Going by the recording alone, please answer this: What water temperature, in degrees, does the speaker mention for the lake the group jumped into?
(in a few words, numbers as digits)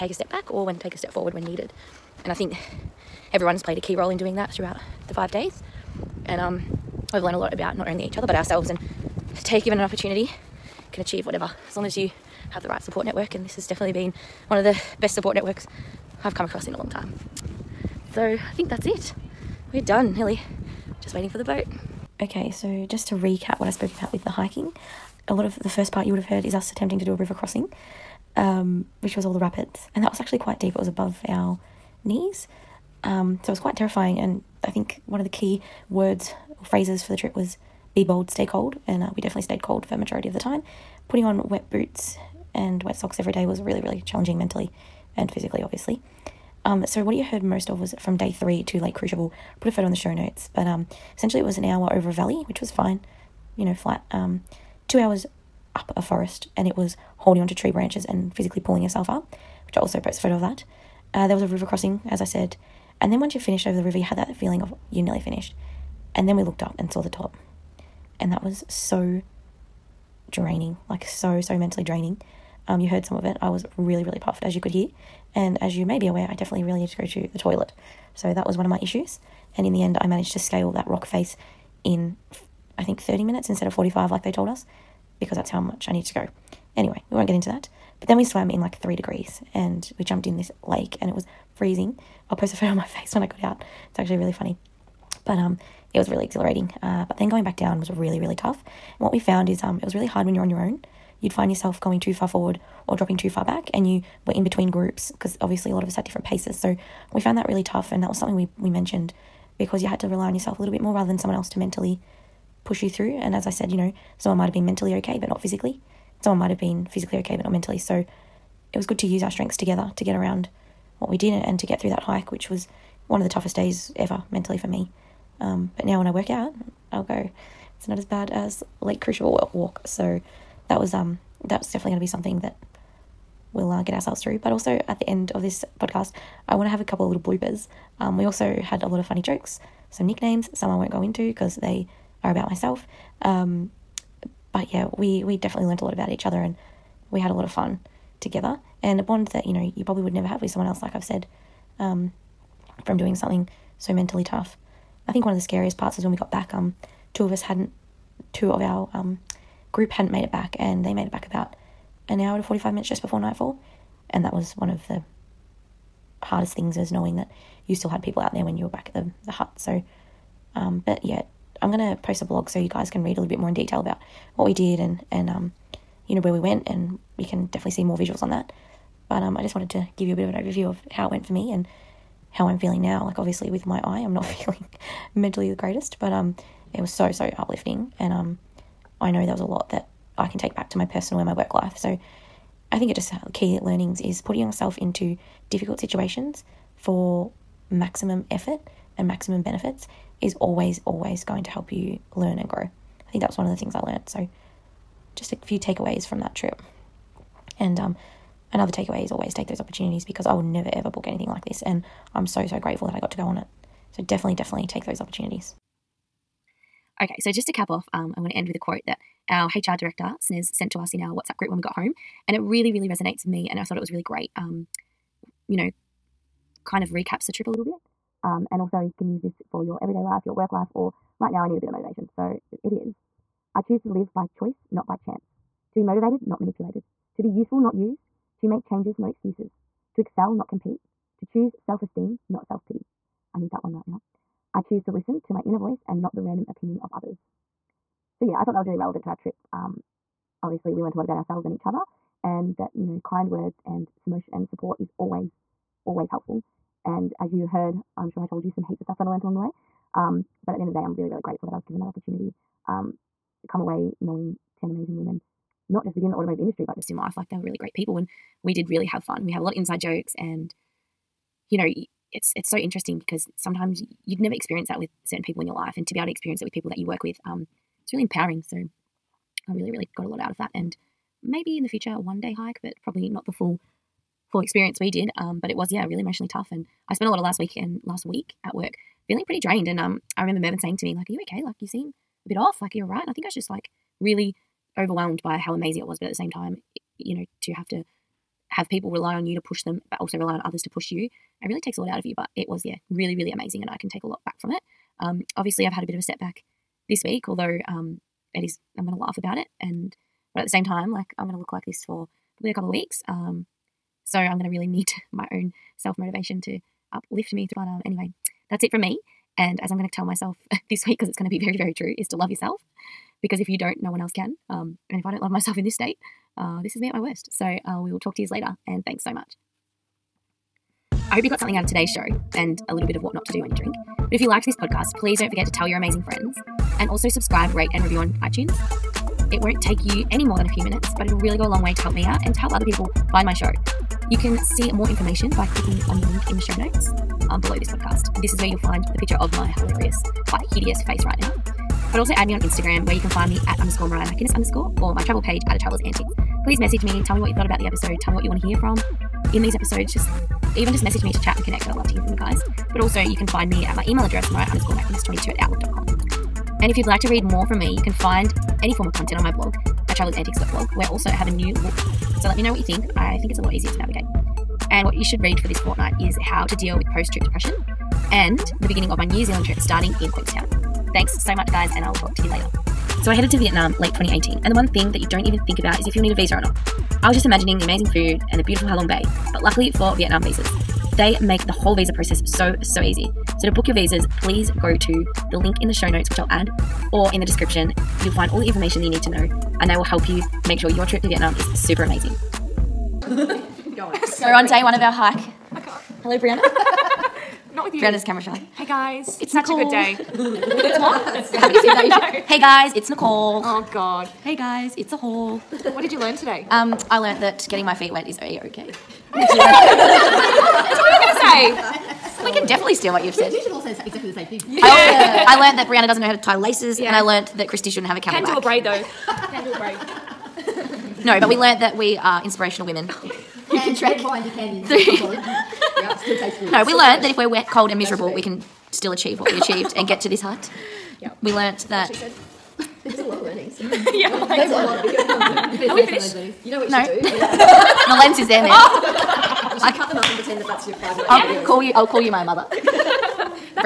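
3.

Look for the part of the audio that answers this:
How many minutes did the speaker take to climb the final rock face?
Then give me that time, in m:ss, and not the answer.
1:23.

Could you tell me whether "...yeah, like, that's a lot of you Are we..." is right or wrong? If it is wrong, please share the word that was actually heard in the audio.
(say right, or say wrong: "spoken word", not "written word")
right.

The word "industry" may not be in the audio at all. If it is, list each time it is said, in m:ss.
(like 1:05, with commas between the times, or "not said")
4:26.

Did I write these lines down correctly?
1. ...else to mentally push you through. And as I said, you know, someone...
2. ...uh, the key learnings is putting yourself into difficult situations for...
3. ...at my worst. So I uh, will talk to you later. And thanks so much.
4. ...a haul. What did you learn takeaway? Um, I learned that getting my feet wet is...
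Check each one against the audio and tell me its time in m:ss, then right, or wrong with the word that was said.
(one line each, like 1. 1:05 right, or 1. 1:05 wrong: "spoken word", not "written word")
1. 1:51 right
2. 3:13 right
3. 5:26 right
4. 6:54 wrong: "today", not "takeaway".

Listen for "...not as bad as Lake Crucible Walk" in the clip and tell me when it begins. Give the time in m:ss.
2:07.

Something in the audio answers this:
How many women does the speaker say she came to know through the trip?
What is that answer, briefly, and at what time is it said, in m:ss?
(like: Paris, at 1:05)
10, at 4:24.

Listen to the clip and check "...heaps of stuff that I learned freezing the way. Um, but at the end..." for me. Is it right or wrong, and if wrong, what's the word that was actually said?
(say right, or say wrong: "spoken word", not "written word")
wrong: "along", not "freezing".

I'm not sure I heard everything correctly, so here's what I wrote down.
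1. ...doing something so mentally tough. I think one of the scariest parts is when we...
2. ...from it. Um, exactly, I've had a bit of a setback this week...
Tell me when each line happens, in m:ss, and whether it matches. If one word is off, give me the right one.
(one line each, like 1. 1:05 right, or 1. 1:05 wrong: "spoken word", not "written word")
1. 2:32 right
2. 5:04 wrong: "obviously", not "exactly".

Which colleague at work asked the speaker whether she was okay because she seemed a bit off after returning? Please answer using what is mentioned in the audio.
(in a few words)
Mervyn.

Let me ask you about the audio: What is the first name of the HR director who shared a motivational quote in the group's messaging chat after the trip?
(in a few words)
Snez.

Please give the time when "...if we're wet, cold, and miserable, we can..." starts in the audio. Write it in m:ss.
7:17.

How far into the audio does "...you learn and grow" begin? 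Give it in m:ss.
3:21.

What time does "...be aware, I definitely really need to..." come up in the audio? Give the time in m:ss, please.
1:15.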